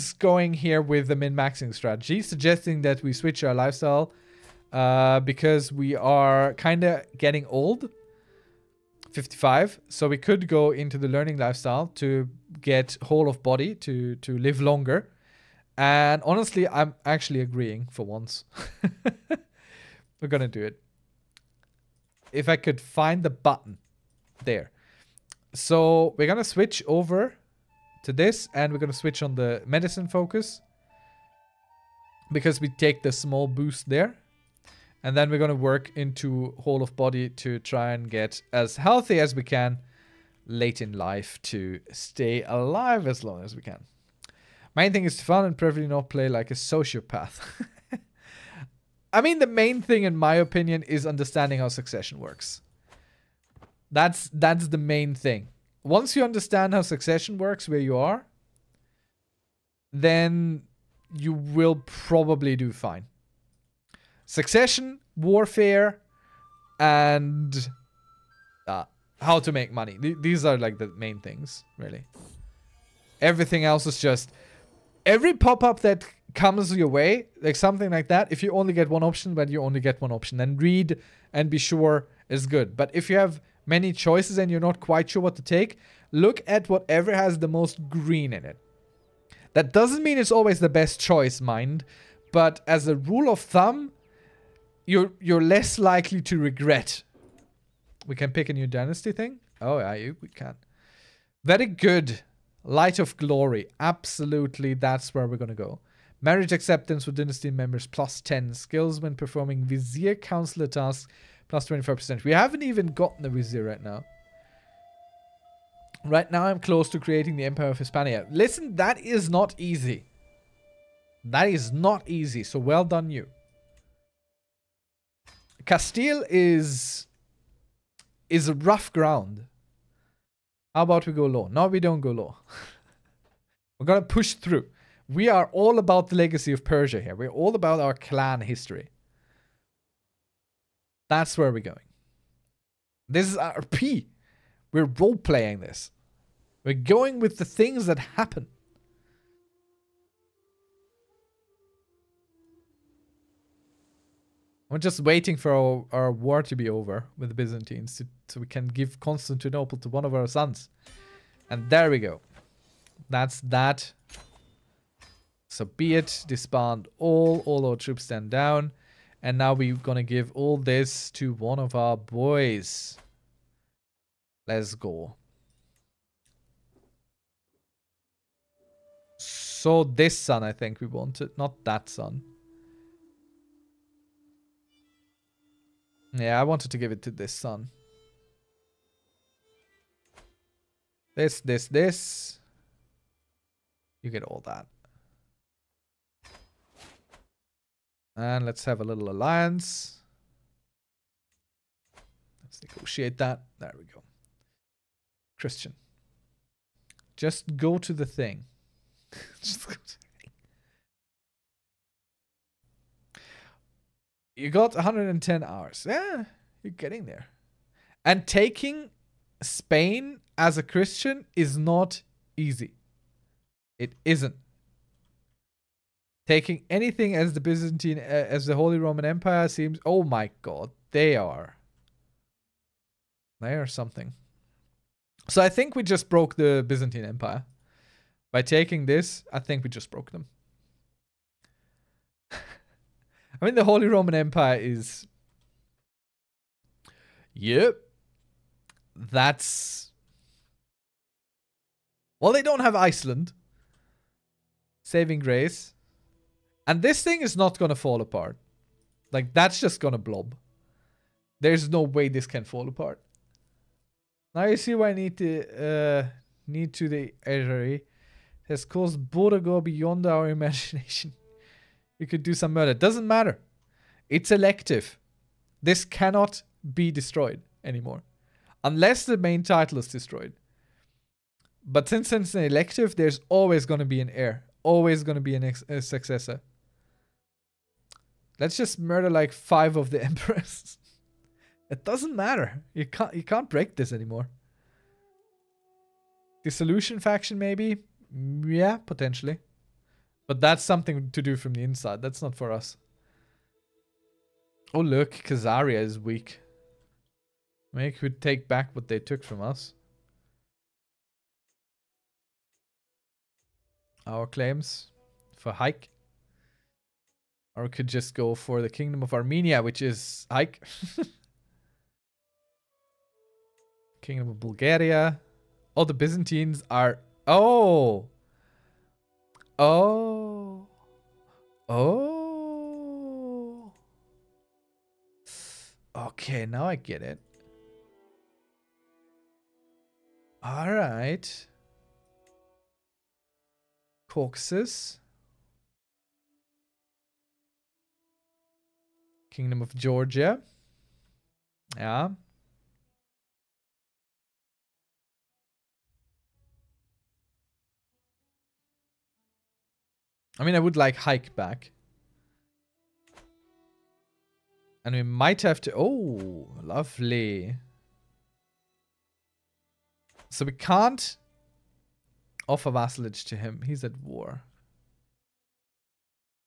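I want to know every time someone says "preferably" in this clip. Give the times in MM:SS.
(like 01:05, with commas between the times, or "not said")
00:45.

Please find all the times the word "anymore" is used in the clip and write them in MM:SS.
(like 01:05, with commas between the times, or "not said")
04:37, 04:53.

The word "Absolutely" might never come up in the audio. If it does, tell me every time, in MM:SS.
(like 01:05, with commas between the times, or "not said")
01:43.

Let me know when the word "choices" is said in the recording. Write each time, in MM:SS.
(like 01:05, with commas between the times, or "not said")
01:23, 01:30.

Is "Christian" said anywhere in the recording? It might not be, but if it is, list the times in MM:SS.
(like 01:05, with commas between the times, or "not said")
03:25, 03:40.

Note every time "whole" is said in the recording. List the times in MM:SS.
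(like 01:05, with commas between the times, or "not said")
00:13, 00:36.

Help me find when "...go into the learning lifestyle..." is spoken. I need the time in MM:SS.
00:10.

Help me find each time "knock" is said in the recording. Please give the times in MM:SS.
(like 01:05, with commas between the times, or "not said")
not said.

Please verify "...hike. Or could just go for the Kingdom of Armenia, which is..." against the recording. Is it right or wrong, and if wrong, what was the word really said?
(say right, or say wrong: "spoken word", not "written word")
right.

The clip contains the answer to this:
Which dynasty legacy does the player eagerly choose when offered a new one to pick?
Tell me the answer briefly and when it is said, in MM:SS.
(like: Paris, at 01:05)
Light of Glory, at 01:42.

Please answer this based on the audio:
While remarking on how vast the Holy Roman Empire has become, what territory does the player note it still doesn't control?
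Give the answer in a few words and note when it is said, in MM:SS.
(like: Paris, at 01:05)
Iceland, at 04:12.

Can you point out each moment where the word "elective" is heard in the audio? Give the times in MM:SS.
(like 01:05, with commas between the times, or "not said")
04:34, 04:42.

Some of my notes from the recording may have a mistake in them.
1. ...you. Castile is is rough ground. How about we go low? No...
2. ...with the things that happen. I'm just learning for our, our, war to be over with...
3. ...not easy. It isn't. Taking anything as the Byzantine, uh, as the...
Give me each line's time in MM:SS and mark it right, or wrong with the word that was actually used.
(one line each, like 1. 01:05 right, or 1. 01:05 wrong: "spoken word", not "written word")
1. 02:03 right
2. 02:27 wrong: "waiting", not "learning"
3. 03:41 right.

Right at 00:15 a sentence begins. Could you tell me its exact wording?
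And honestly, I'm actually agreeing for once.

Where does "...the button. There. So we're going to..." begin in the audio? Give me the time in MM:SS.
00:23.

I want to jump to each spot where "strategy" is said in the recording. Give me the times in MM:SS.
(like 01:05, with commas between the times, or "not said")
00:01.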